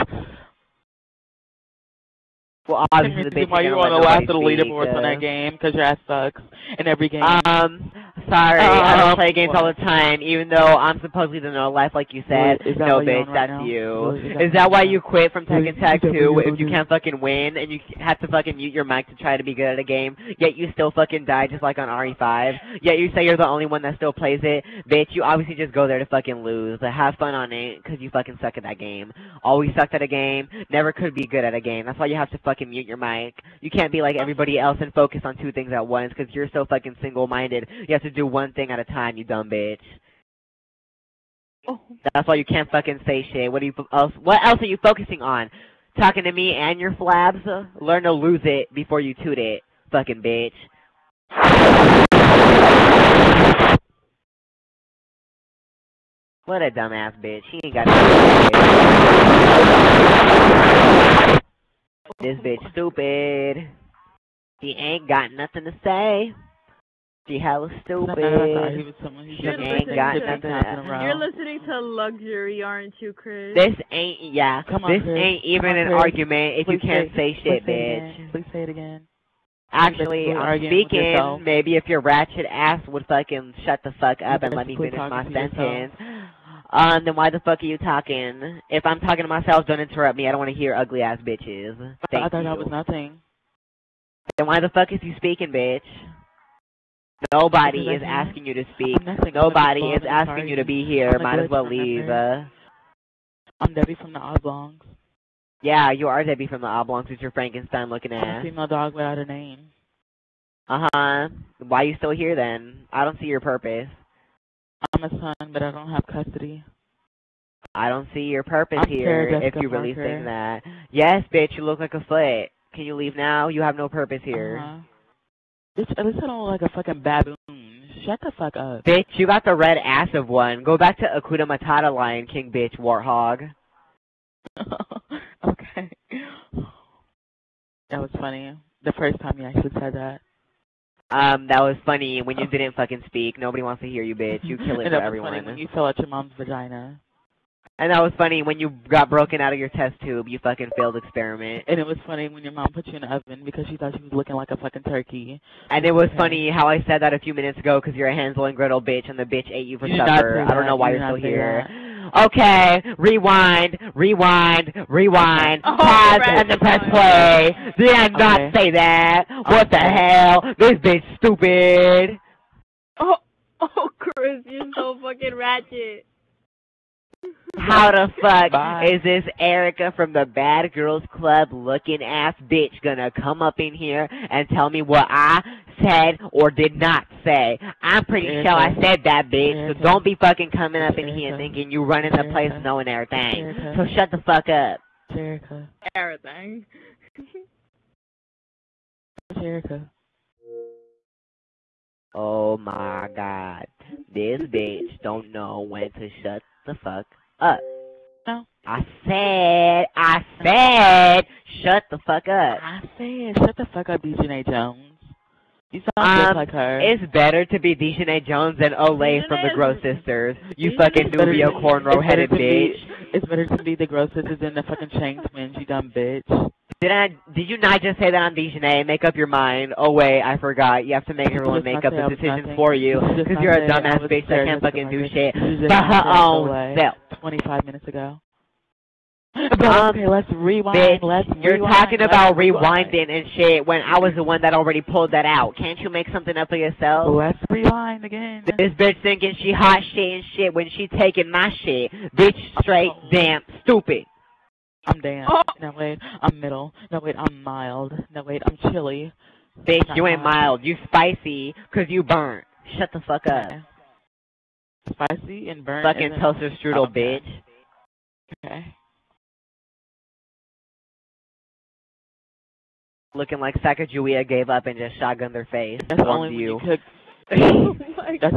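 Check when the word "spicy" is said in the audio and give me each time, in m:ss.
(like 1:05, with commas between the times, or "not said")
4:20, 4:24.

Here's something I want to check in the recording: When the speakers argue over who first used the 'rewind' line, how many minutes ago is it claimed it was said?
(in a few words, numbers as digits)
25.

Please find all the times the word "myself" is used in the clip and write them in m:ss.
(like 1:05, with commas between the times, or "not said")
1:29.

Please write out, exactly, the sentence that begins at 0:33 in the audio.
You can't be like everybody else and focus on two things at once because you're so fucking single-minded.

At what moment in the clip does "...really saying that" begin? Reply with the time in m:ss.
1:59.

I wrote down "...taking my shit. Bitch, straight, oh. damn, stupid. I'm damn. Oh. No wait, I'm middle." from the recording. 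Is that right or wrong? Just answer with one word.
right.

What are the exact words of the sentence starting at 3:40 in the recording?
You fucking Nubio cornrow headed bitch.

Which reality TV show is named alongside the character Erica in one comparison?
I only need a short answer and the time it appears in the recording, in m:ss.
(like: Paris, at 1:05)
Bad Girls Club, at 3:00.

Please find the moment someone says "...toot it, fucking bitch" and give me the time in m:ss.
0:49.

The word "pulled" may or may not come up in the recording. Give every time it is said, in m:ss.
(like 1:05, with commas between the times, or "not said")
4:04.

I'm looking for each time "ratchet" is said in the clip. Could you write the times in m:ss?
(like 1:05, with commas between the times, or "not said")
1:21, 2:55.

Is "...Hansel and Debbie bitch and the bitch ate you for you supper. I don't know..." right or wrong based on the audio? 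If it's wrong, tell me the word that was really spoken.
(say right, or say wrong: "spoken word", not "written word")
wrong: "Gretel", not "Debbie".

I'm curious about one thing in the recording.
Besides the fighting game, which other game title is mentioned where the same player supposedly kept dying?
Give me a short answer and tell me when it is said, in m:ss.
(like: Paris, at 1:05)
RE5, at 0:21.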